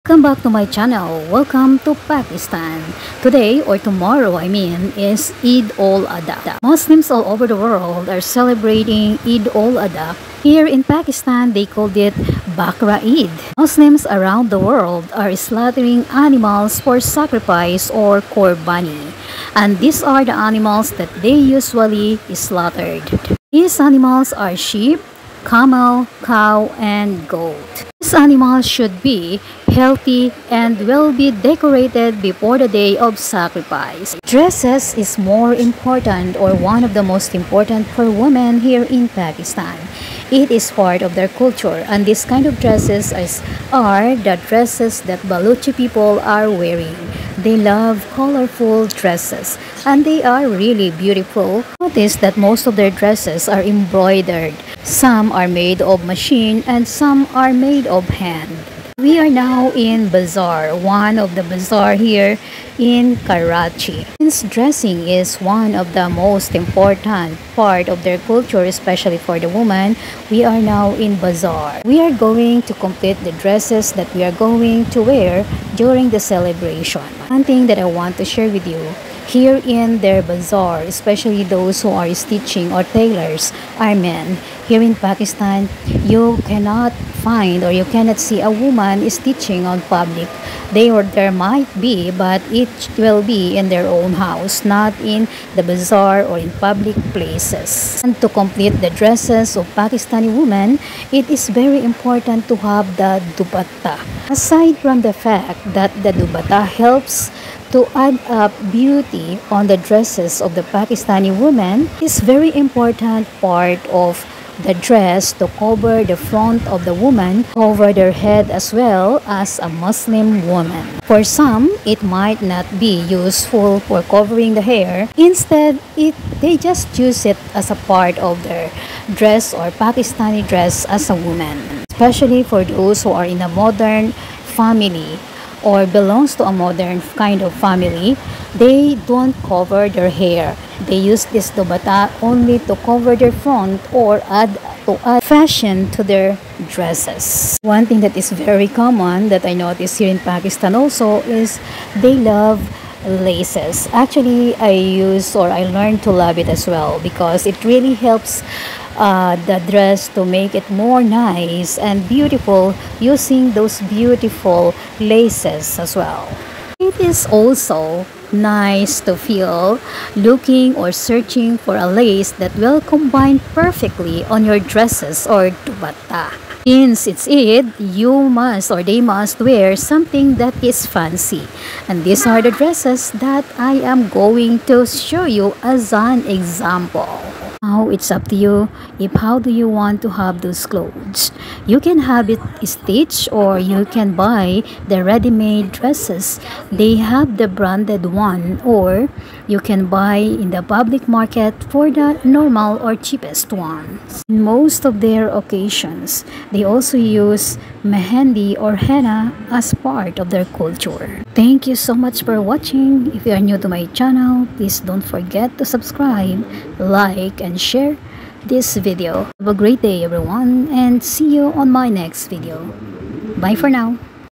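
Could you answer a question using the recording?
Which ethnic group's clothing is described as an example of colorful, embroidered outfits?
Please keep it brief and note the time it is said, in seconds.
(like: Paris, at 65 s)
Baluchi, at 45 s.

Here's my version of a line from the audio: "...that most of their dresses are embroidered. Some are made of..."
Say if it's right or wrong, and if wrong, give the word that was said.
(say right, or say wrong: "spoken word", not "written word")
right.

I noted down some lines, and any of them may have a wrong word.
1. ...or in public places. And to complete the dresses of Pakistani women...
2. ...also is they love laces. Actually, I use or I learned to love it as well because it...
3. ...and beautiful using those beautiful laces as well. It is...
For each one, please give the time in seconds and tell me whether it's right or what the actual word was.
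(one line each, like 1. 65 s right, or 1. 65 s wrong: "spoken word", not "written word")
1. 96 s right
2. 150 s right
3. 161 s right.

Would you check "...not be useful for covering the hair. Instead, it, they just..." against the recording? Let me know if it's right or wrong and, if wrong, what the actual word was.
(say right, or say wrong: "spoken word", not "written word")
right.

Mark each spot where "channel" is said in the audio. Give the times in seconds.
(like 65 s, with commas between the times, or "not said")
0 s, 213 s.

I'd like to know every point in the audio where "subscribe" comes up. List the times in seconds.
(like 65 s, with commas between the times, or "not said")
215 s.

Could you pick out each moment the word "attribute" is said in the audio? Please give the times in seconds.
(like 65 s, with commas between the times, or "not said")
not said.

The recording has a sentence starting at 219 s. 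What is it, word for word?
Have a great day everyone and see you on my next video.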